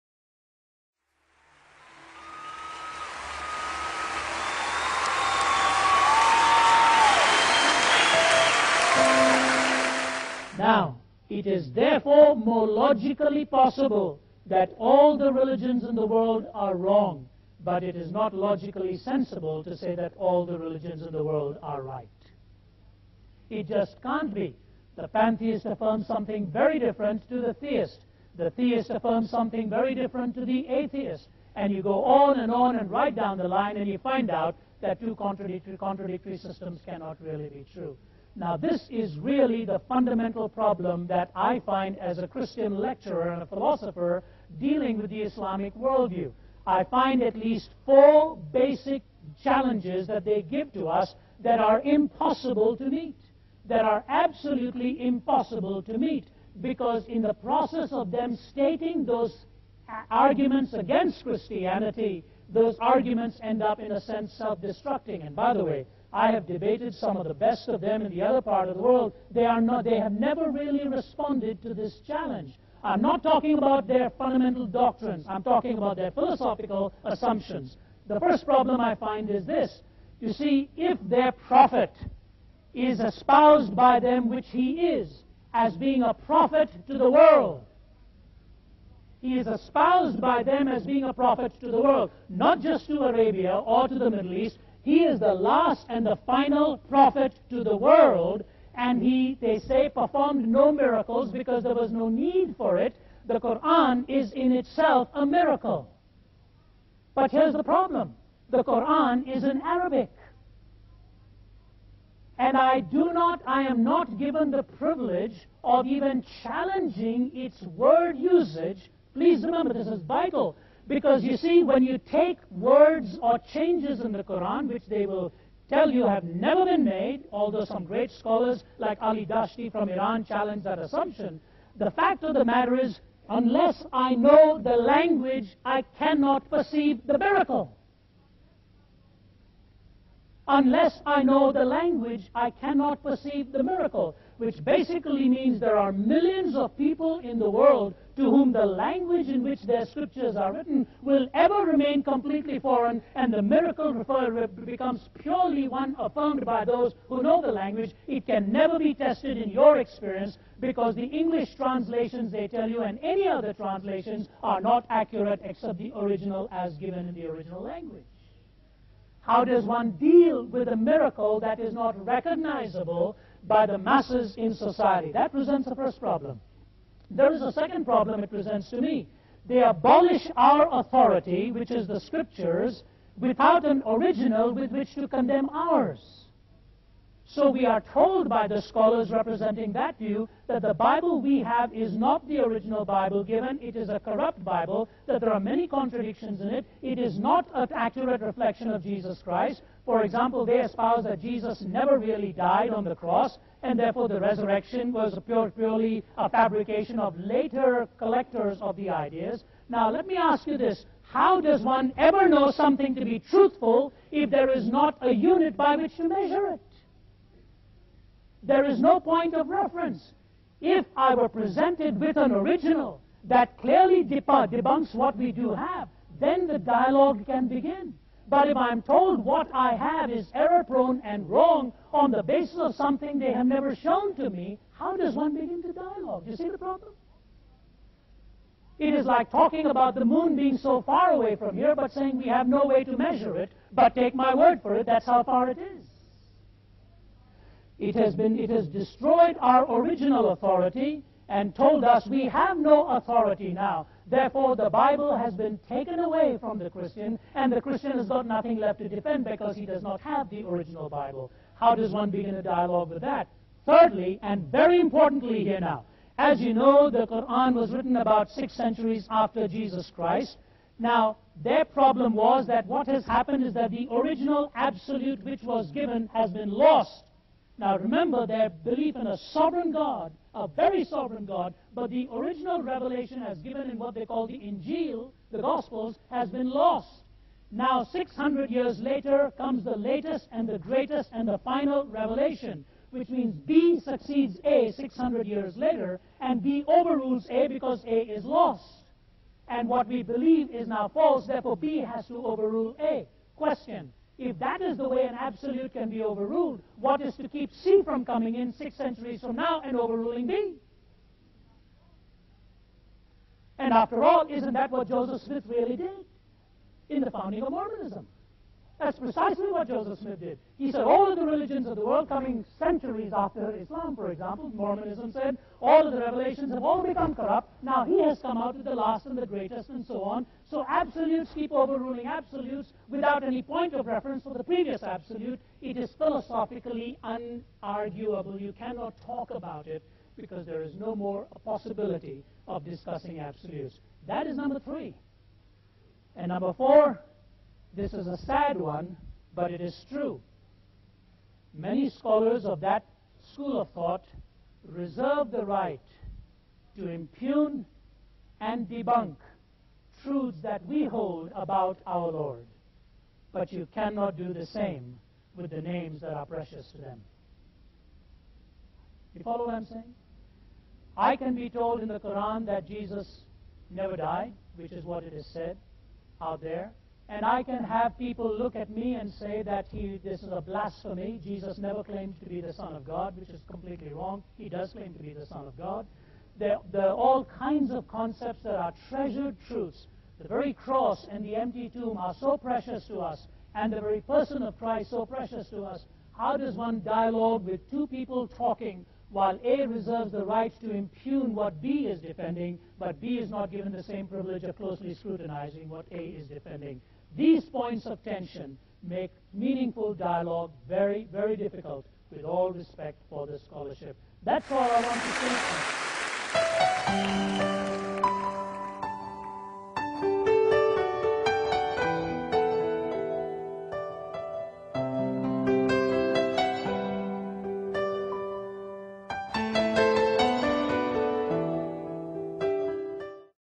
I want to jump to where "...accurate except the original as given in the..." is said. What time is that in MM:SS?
02:44.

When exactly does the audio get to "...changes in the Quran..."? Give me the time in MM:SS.
02:03.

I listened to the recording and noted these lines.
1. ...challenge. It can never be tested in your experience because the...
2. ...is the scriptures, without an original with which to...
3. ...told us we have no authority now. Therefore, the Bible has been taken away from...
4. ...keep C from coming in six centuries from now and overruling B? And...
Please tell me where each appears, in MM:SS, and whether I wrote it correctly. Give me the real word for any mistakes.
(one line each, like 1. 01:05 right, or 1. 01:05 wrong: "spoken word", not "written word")
1. 02:37 wrong: "language", not "challenge"
2. 03:01 right
3. 04:11 right
4. 05:07 right.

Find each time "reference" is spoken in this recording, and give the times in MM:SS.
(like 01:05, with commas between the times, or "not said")
03:39, 05:33.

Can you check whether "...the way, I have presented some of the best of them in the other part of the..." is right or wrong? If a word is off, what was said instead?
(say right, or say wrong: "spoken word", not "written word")
wrong: "debated", not "presented".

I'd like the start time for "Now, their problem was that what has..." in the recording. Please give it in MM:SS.
04:30.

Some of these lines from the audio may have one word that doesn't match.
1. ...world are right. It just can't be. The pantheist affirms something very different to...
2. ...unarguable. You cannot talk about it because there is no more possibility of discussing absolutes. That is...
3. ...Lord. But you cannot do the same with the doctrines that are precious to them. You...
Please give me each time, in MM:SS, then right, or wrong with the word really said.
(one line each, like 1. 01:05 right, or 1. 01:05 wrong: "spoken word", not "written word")
1. 00:21 right
2. 05:37 right
3. 06:02 wrong: "names", not "doctrines".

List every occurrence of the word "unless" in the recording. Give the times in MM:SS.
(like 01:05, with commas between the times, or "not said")
02:13, 02:20.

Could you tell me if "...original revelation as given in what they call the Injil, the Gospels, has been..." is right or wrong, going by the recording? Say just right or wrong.
right.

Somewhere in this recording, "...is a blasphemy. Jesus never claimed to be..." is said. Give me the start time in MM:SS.
06:20.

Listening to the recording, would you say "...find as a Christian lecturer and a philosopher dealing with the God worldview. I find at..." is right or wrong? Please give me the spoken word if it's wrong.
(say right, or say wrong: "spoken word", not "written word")
wrong: "Islamic", not "God".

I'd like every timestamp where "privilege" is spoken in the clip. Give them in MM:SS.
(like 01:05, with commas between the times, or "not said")
01:54, 06:44.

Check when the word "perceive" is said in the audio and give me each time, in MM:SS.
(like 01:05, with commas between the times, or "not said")
02:16, 02:23.